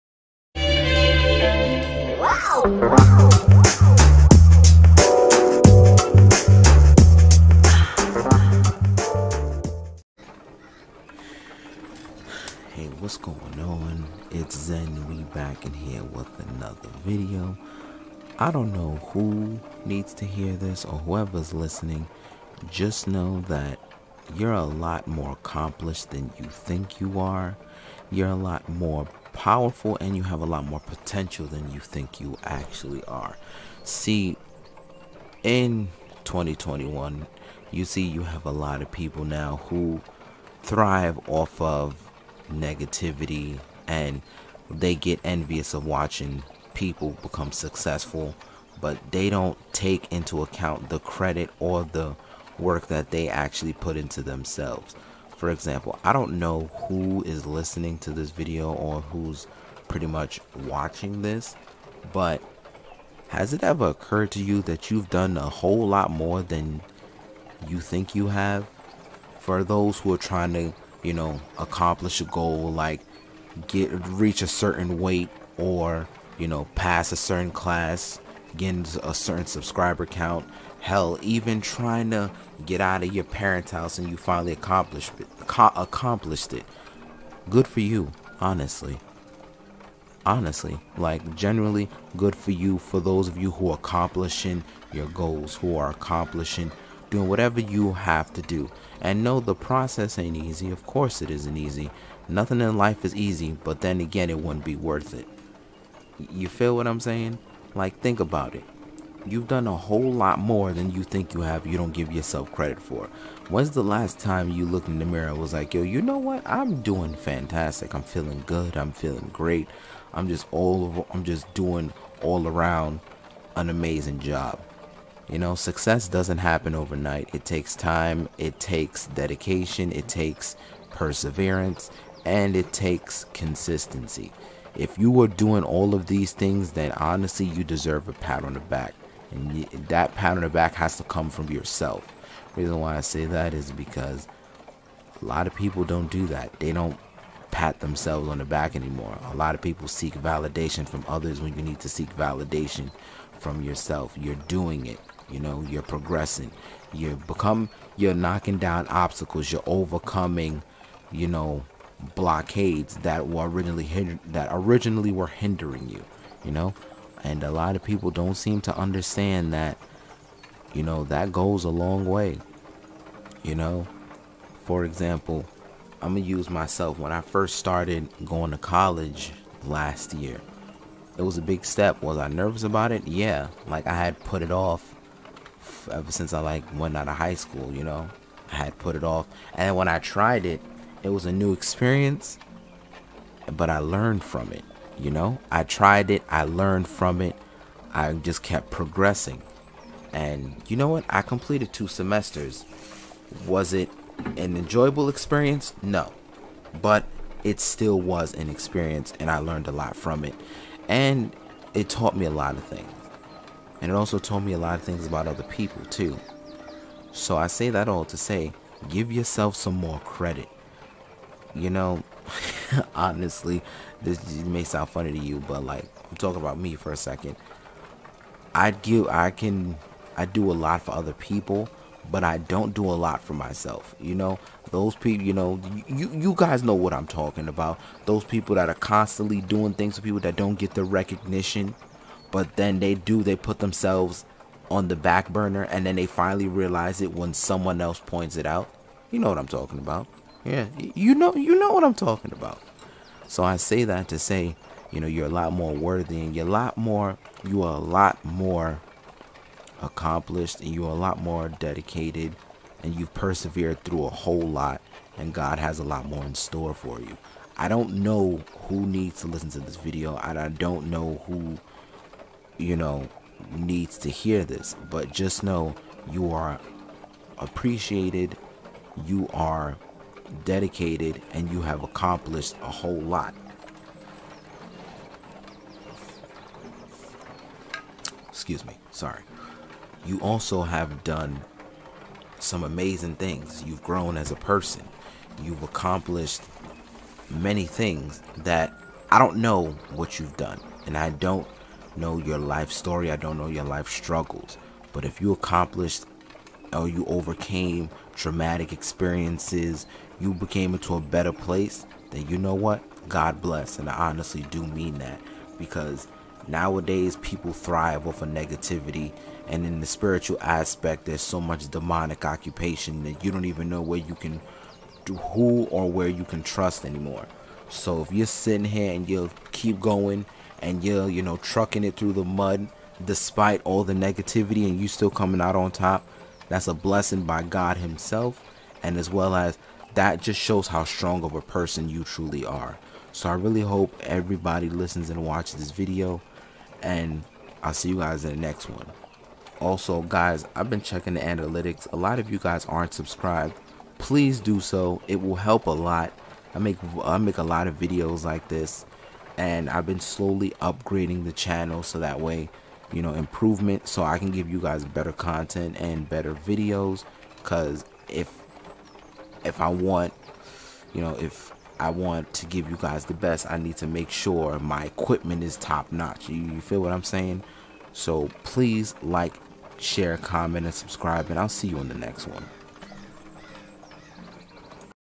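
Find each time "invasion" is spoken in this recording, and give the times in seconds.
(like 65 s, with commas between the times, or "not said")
not said.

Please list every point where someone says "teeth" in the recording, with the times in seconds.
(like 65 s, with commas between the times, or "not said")
not said.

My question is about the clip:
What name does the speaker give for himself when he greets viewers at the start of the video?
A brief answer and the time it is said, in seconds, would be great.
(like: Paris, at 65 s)
Zen, at 14 s.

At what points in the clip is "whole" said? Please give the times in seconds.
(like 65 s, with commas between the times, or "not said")
65 s, 109 s, 264 s, 282 s.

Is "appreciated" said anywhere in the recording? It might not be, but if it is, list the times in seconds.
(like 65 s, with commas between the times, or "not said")
277 s.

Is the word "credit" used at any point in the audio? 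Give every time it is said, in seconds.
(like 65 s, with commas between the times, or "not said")
50 s, 112 s, 220 s.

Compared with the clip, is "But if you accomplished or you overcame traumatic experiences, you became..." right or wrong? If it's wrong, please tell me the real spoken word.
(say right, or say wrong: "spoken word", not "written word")
right.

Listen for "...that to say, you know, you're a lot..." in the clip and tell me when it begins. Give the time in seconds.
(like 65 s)
253 s.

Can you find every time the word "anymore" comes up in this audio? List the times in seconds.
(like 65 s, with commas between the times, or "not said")
148 s, 326 s.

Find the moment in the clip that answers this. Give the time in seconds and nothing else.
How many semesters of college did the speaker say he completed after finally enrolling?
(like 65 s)
201 s.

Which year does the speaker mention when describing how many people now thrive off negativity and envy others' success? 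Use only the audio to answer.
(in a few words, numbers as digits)
2021.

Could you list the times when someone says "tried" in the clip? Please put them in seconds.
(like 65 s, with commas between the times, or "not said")
189 s, 195 s.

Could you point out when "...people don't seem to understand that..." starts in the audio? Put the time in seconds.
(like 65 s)
167 s.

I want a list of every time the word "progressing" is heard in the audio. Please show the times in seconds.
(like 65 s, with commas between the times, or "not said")
155 s, 198 s.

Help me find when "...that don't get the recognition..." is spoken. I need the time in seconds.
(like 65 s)
240 s.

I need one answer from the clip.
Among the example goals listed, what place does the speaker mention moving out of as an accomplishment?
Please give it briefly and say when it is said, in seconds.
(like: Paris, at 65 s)
parents' house, at 83 s.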